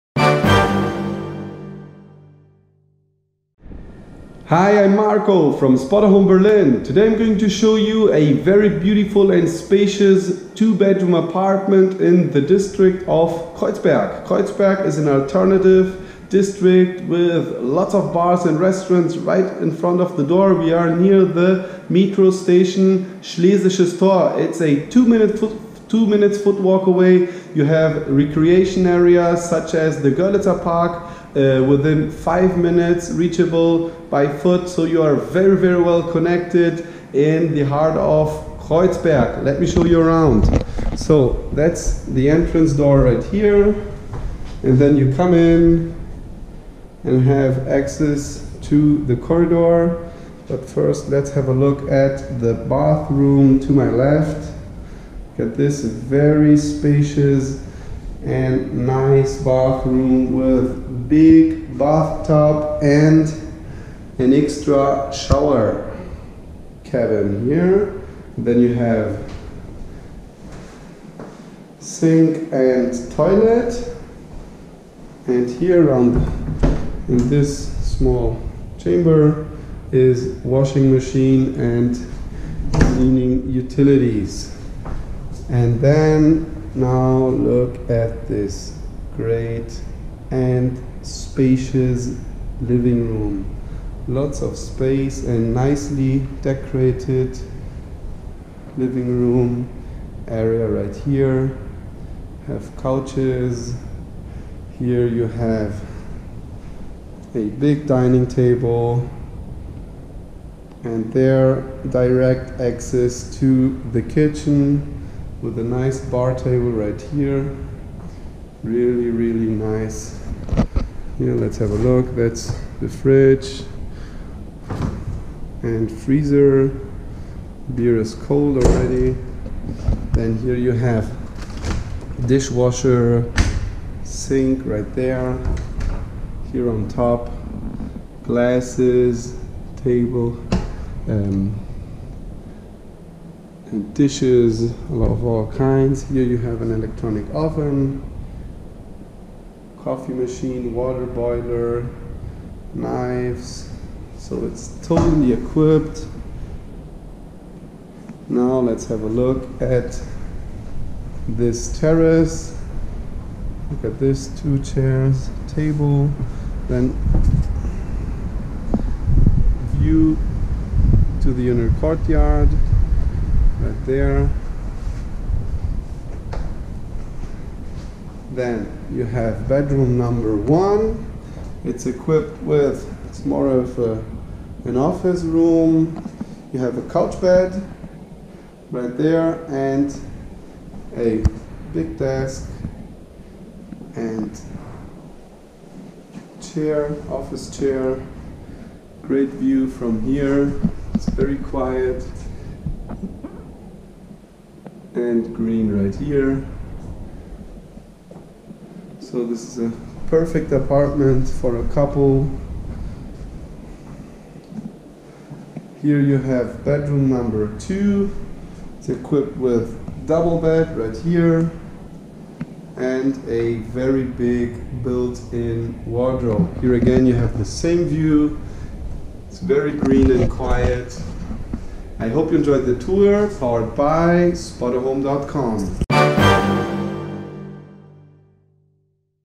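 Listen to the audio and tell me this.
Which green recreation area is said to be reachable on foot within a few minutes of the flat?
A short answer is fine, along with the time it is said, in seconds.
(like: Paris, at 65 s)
Görlitzer Park, at 30 s.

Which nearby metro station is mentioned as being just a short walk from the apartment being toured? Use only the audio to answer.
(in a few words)
Schlesisches Tor.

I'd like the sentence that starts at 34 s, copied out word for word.
So you are very, very well connected in the heart of Kreuzberg.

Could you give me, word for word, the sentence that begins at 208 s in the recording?
So this is a perfect apartment for a couple.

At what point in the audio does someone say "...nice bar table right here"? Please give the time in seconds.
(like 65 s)
115 s.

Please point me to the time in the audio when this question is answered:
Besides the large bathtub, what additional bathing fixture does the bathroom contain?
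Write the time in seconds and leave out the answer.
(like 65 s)
65 s.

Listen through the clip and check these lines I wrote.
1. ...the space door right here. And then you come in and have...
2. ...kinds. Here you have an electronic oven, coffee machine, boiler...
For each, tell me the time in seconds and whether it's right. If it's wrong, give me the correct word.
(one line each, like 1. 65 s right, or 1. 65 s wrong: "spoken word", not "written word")
1. 42 s wrong: "entrance", not "space"
2. 145 s wrong: "water", not "boiler".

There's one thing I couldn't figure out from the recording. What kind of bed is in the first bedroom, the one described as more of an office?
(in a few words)
couch bed.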